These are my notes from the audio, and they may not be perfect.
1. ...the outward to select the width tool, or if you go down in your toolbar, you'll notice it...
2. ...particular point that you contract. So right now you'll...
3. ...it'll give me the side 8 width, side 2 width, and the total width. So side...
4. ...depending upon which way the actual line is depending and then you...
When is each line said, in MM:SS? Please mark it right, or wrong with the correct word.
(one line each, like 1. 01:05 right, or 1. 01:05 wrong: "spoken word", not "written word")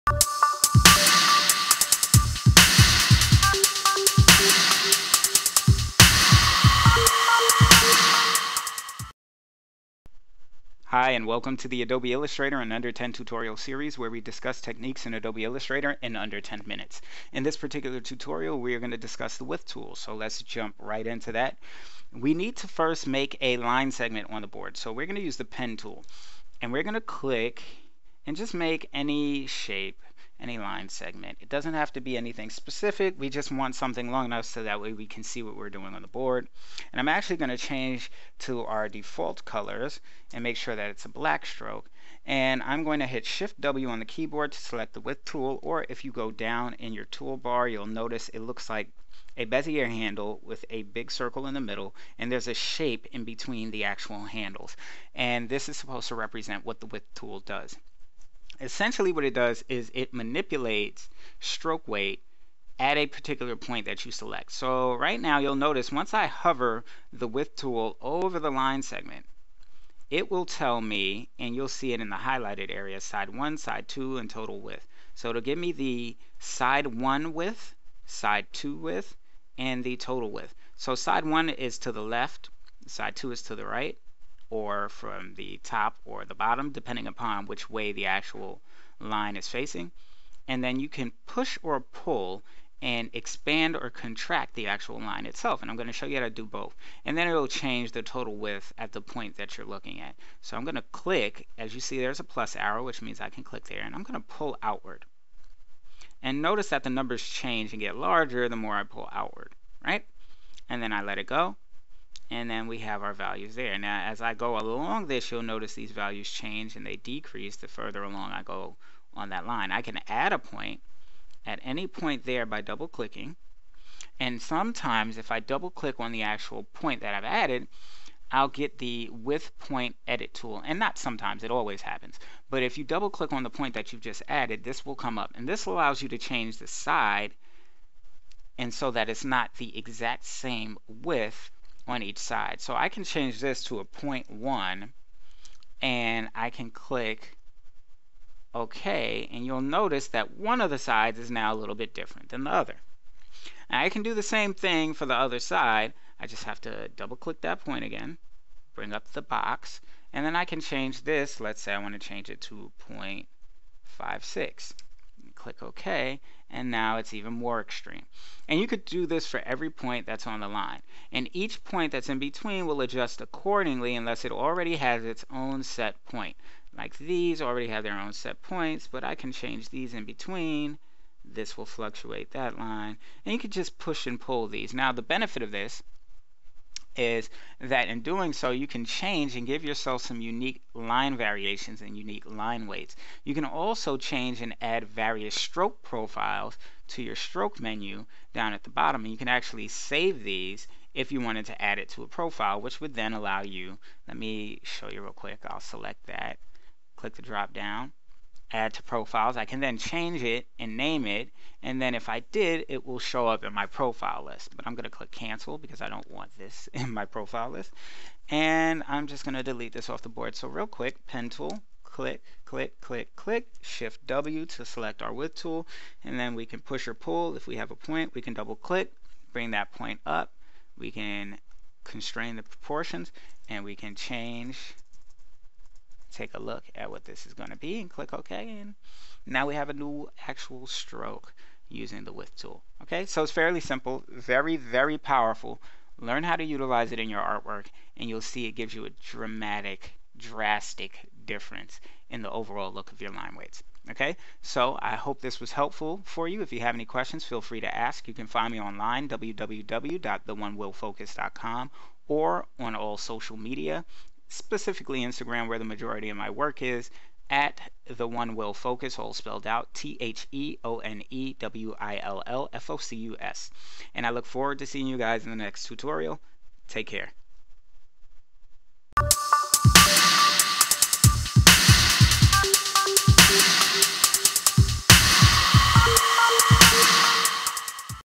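1. 00:43 wrong: "keyboard", not "outward"
2. 01:03 wrong: "select", not "contract"
3. 01:15 wrong: "1", not "8"
4. 01:26 wrong: "facing", not "depending".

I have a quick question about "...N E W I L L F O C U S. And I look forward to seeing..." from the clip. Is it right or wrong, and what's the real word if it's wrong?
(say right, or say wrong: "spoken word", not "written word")
right.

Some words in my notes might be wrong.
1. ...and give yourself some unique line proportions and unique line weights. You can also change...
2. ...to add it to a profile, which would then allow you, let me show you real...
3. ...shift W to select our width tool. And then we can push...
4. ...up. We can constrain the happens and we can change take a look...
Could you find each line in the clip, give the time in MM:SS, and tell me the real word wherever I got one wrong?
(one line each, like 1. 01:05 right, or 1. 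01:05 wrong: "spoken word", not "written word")
1. 03:09 wrong: "variations", not "proportions"
2. 03:21 right
3. 03:43 right
4. 03:50 wrong: "proportions", not "happens".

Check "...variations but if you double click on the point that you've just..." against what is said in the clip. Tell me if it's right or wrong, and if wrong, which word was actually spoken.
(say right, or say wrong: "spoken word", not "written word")
wrong: "happens", not "variations".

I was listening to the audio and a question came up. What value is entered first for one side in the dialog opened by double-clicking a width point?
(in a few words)
0.1.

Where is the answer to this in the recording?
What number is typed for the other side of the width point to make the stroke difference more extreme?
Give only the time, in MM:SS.
02:42.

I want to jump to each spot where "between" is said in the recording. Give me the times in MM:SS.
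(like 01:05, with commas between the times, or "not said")
00:53, 02:52, 03:00.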